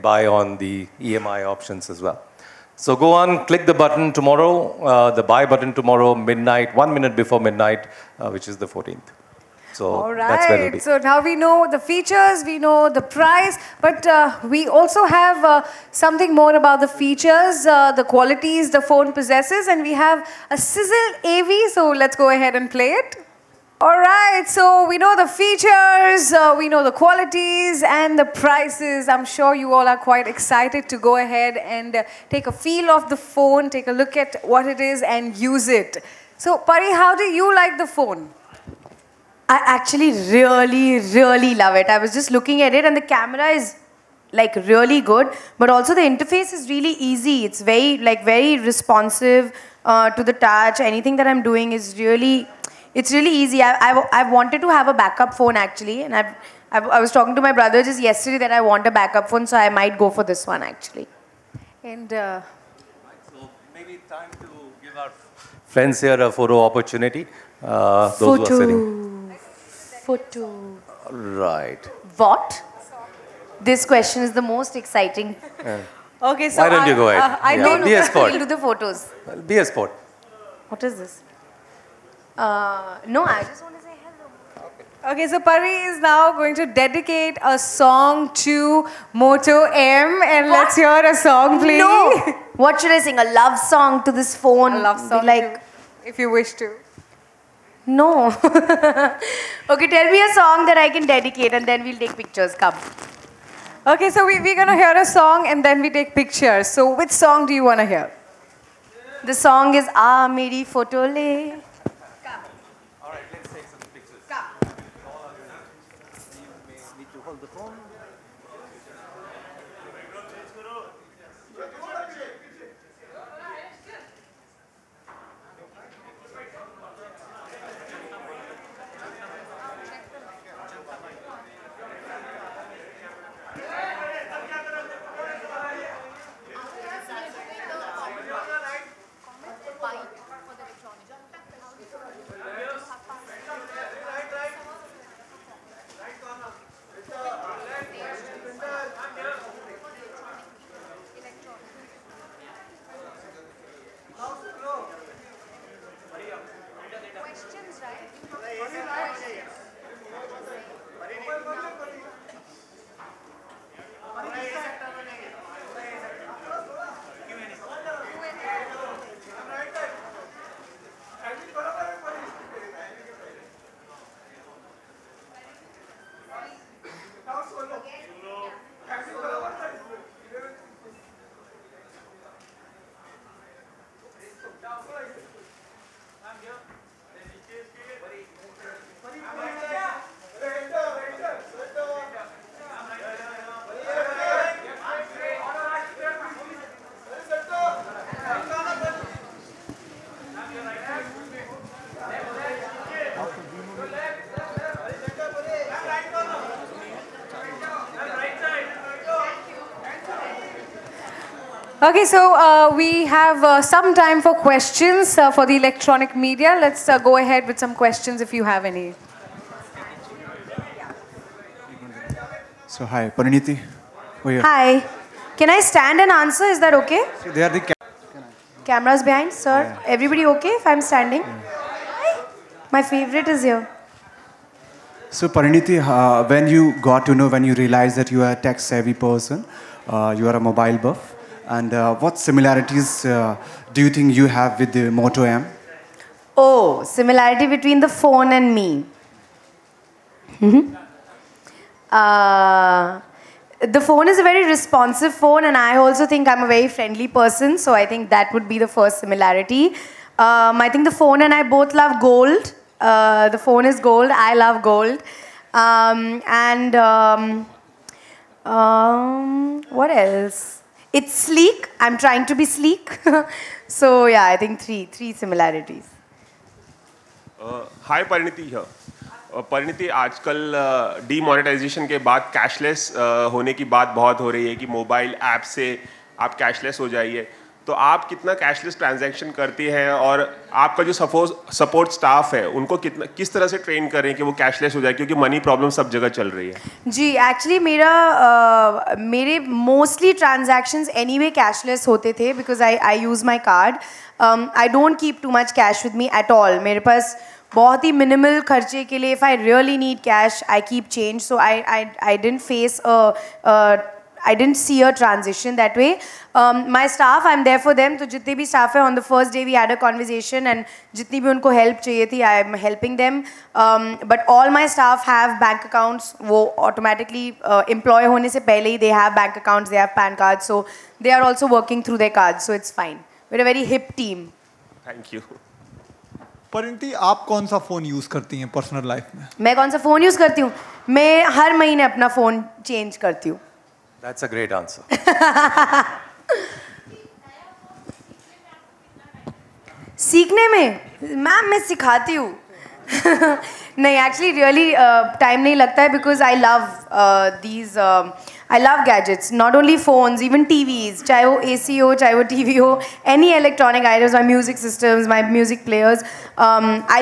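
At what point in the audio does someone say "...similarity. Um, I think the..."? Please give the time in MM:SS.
04:18.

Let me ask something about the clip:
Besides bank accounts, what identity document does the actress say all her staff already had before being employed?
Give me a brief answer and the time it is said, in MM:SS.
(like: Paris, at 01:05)
PAN cards, at 05:29.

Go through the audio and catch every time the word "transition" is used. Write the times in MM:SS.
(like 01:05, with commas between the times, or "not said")
05:14.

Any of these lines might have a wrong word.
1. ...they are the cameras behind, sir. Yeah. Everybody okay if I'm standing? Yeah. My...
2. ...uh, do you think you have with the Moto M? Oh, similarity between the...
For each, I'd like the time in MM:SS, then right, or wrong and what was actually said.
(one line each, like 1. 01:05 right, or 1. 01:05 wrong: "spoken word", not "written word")
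1. 03:47 right
2. 04:03 right.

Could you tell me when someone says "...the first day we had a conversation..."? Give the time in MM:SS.
05:18.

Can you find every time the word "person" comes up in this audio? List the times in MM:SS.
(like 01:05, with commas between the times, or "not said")
03:58, 04:17.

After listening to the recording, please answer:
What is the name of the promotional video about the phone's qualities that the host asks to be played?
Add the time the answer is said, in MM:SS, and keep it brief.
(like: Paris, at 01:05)
Sizzle AV, at 00:20.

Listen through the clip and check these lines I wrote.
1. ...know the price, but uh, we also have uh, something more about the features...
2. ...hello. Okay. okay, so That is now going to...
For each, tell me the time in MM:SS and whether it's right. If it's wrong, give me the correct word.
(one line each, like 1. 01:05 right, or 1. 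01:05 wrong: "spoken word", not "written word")
1. 00:12 right
2. 01:24 wrong: "Pari", not "That".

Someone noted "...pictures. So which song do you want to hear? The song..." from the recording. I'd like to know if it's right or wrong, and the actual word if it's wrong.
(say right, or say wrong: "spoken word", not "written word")
right.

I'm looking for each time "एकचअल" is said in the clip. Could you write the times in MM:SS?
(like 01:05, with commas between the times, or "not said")
04:57, 05:54.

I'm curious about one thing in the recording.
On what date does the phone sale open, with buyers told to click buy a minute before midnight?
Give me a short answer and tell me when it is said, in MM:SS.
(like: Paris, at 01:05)
14th, at 00:08.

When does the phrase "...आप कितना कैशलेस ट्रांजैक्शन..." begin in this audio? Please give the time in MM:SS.
04:47.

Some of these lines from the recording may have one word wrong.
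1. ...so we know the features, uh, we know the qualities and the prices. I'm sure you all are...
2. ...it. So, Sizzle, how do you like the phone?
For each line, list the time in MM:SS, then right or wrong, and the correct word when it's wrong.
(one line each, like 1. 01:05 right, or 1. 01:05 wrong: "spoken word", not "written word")
1. 00:24 right
2. 00:35 wrong: "Pari", not "Sizzle".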